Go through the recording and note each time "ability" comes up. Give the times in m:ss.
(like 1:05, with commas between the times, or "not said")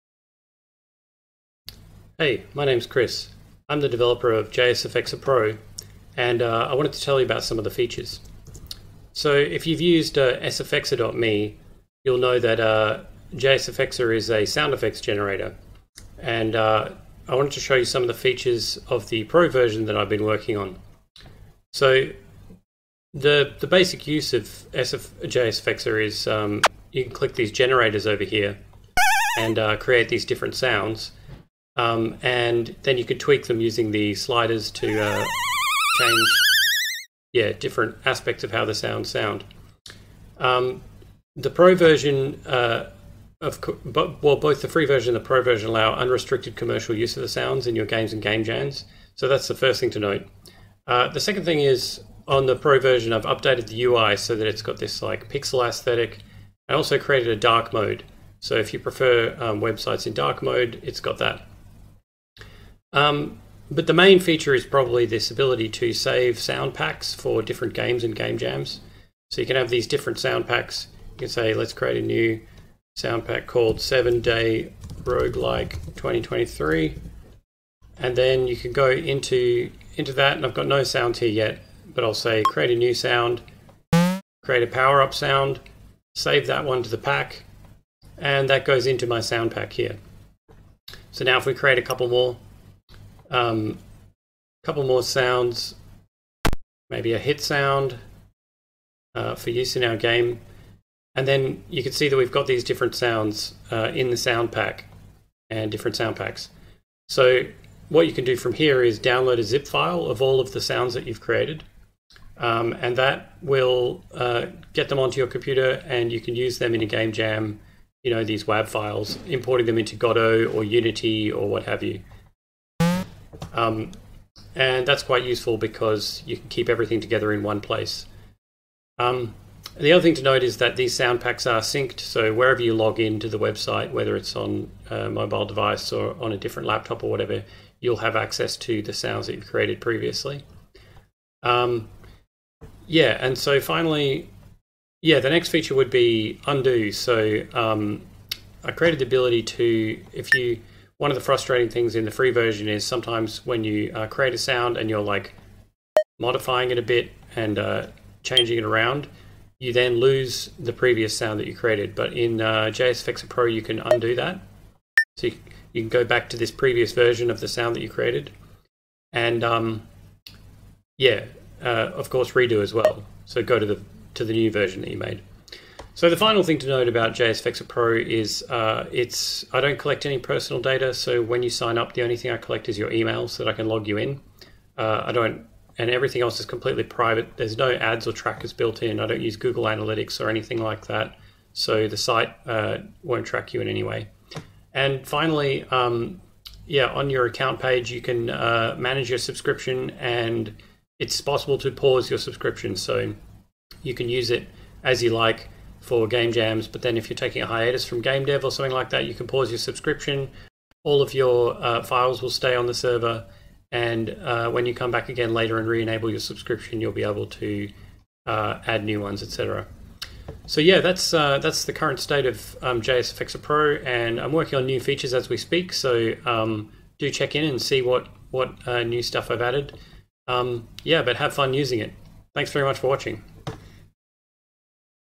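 1:05, 2:29.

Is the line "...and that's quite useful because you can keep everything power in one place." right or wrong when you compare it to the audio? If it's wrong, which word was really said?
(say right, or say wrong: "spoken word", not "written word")
wrong: "together", not "power".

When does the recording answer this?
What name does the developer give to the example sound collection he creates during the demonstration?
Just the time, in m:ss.
1:13.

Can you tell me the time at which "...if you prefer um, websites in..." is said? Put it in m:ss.
0:58.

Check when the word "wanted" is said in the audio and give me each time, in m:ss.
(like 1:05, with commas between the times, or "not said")
0:06, 0:17.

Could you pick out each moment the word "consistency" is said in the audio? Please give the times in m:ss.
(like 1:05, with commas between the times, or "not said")
not said.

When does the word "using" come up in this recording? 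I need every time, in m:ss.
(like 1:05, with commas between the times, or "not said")
0:33, 3:51.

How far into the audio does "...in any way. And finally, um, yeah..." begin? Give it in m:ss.
3:13.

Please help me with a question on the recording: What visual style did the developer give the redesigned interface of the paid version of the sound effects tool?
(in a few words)
Pixel aesthetic.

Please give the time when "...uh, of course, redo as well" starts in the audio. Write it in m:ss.
2:51.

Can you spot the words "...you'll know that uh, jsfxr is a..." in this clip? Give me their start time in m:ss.
0:12.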